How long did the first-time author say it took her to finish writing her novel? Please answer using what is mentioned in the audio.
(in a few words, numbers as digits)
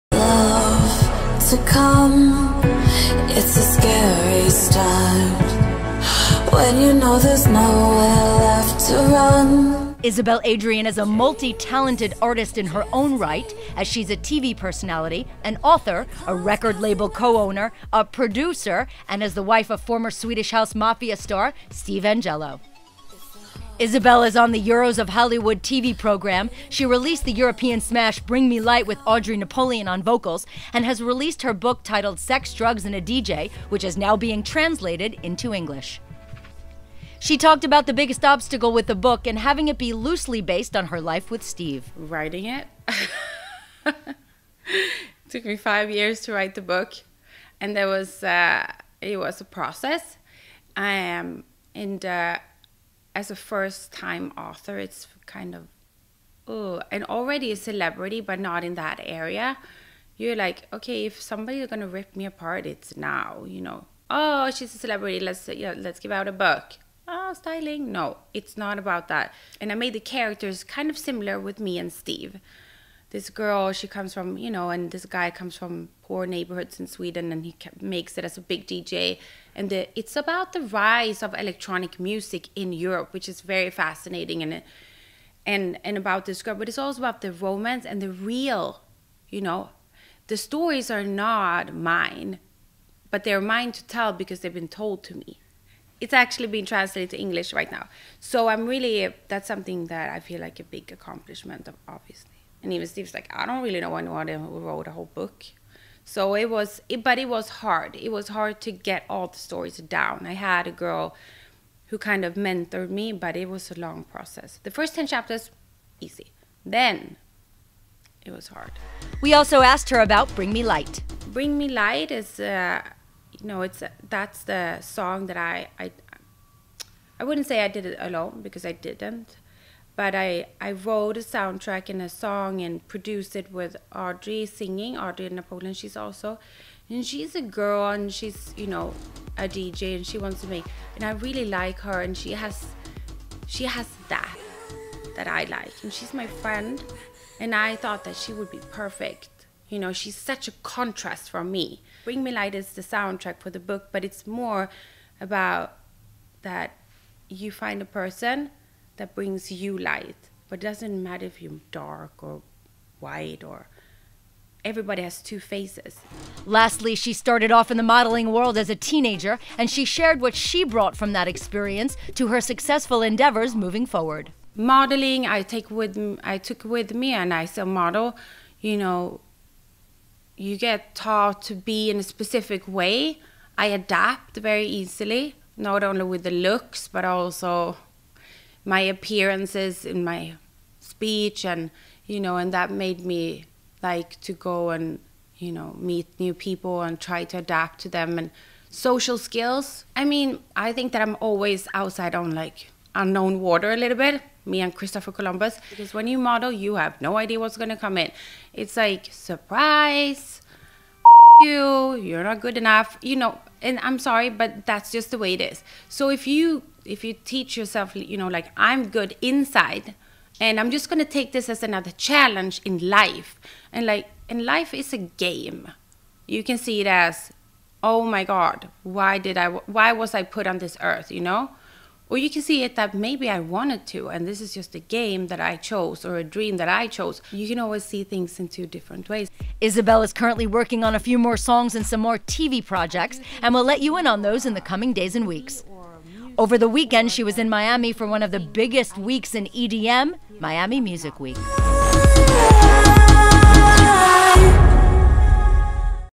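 5 years.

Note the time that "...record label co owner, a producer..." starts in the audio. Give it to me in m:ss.
0:16.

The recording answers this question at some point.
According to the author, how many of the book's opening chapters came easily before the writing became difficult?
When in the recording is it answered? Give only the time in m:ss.
1:54.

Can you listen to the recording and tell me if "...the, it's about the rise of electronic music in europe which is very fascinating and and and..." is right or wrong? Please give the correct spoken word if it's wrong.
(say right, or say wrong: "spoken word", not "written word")
right.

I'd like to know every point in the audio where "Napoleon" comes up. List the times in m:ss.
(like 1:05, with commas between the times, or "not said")
0:29, 2:15.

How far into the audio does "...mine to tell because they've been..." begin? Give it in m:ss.
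1:33.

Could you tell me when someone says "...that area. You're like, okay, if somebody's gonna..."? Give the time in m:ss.
0:58.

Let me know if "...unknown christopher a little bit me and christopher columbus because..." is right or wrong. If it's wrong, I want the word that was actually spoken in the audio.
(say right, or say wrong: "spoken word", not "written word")
wrong: "water", not "christopher".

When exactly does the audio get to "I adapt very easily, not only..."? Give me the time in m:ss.
3:03.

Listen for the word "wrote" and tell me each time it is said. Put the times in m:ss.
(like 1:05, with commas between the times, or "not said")
1:44, 2:10.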